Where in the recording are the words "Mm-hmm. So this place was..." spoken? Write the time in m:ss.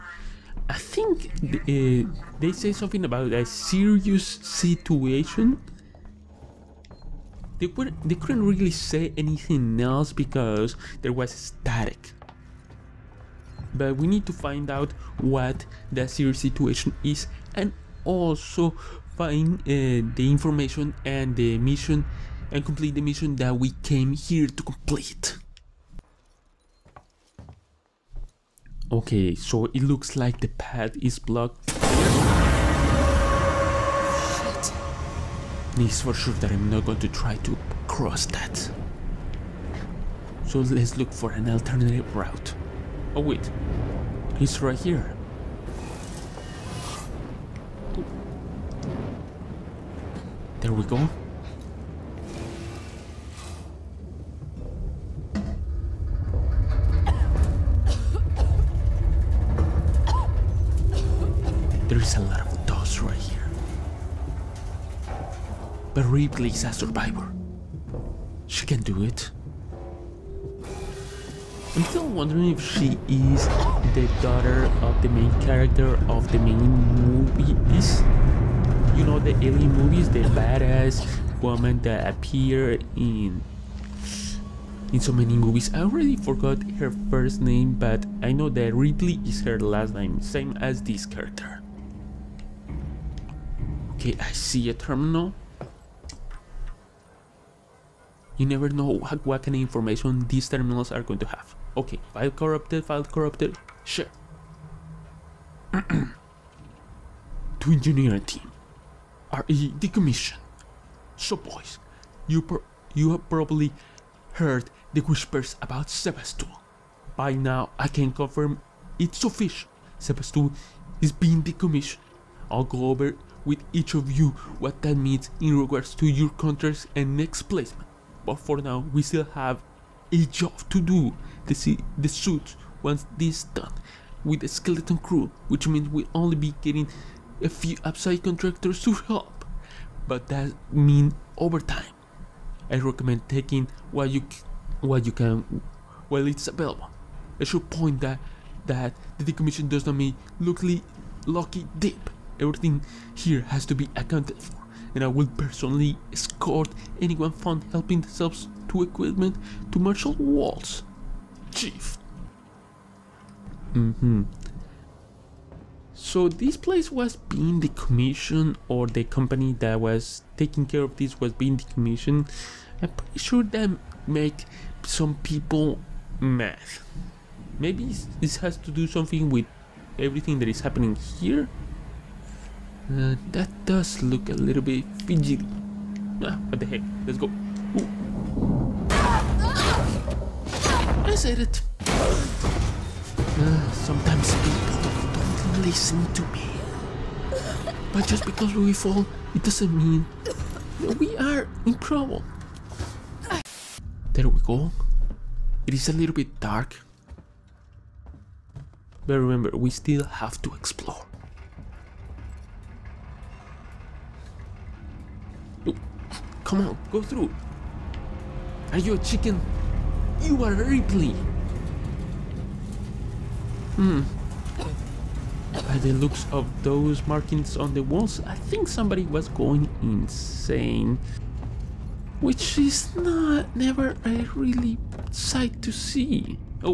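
2:43.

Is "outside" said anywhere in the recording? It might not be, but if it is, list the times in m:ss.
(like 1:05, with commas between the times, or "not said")
2:17.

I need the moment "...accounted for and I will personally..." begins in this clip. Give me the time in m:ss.
2:33.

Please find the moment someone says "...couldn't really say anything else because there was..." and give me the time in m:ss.
0:08.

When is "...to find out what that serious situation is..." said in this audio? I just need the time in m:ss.
0:14.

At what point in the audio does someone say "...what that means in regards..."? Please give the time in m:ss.
2:04.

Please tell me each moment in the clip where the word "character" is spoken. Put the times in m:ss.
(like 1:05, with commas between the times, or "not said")
1:15, 1:31.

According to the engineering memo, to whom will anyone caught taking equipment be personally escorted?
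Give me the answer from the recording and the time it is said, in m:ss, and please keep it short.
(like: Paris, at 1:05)
Marshal Waits, at 2:39.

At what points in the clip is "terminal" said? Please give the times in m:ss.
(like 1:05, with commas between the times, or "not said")
1:34, 1:40.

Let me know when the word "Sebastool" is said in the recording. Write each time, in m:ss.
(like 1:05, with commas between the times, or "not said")
1:55, 1:59.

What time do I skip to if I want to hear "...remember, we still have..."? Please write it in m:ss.
3:29.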